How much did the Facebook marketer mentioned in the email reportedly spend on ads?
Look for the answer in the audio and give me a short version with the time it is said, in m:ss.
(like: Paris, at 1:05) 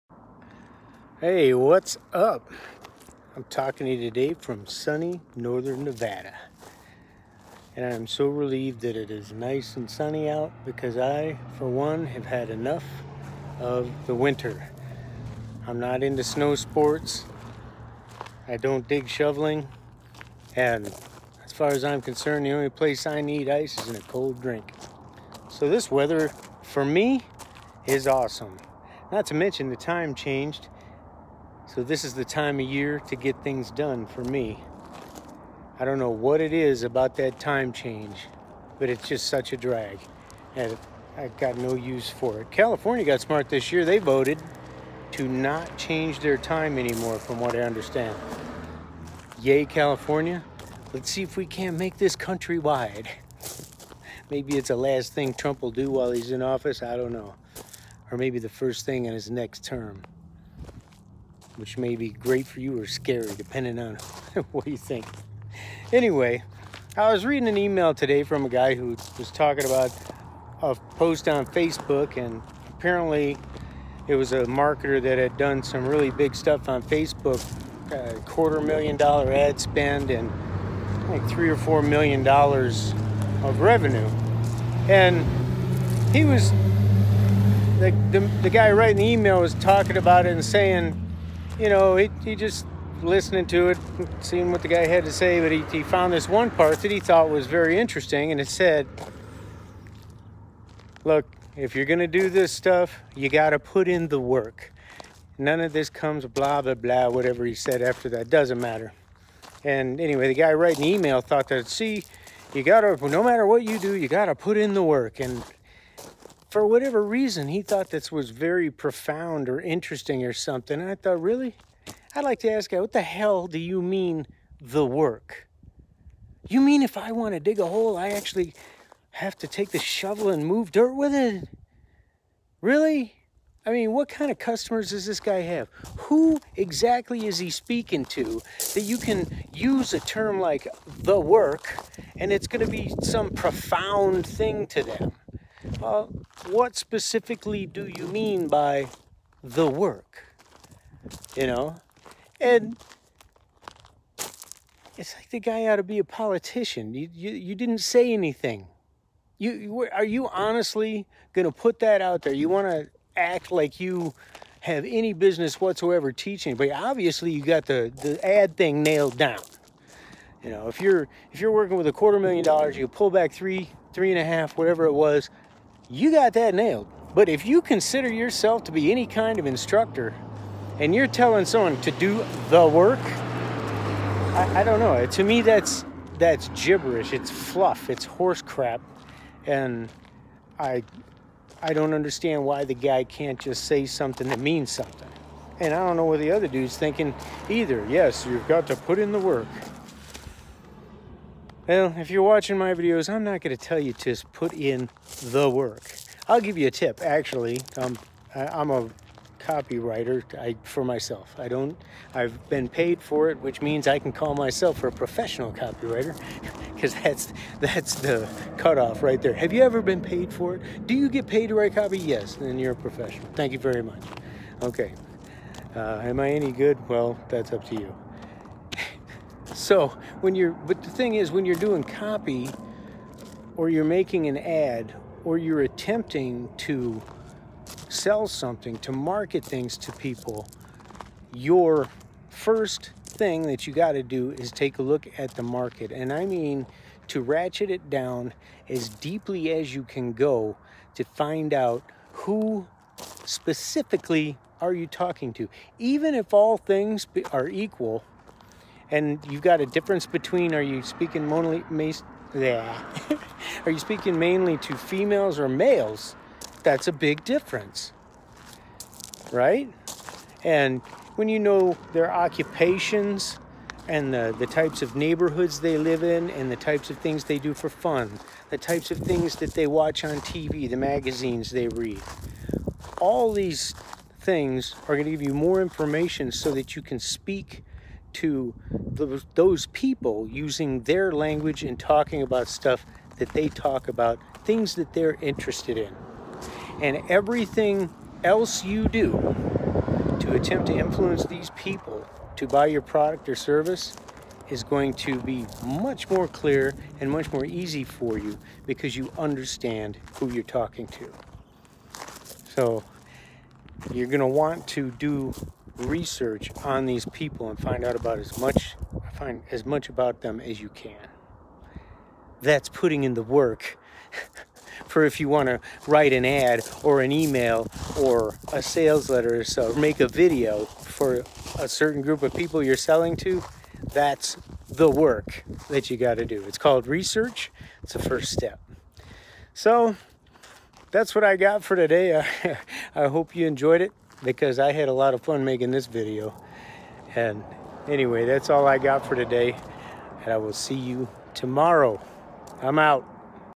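quarter million dollars, at 1:18.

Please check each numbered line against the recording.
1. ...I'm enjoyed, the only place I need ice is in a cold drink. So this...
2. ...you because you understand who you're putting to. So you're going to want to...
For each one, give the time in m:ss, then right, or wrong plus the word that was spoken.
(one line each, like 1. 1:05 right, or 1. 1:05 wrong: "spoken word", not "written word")
1. 0:21 wrong: "concerned", not "enjoyed"
2. 5:08 wrong: "talking", not "putting".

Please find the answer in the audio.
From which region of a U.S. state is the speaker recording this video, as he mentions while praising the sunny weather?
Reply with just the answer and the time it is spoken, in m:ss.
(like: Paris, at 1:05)
northern Nevada, at 0:05.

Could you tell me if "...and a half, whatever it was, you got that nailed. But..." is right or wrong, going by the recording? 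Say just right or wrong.
right.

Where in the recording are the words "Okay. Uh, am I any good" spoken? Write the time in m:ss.
3:44.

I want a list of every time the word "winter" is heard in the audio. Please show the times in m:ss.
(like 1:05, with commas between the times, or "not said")
0:14.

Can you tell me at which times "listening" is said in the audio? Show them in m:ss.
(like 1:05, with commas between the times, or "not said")
1:33.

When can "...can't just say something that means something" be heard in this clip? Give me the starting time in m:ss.
3:13.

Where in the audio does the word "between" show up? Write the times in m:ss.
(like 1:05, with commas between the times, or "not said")
4:20.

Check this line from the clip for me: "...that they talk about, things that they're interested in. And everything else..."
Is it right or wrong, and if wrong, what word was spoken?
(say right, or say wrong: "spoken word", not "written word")
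right.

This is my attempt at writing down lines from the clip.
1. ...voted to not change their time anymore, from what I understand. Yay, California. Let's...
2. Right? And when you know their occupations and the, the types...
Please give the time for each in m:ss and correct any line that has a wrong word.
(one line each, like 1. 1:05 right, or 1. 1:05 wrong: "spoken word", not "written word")
1. 0:43 right
2. 4:29 right.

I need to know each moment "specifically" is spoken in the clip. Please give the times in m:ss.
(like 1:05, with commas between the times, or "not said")
2:26, 4:13.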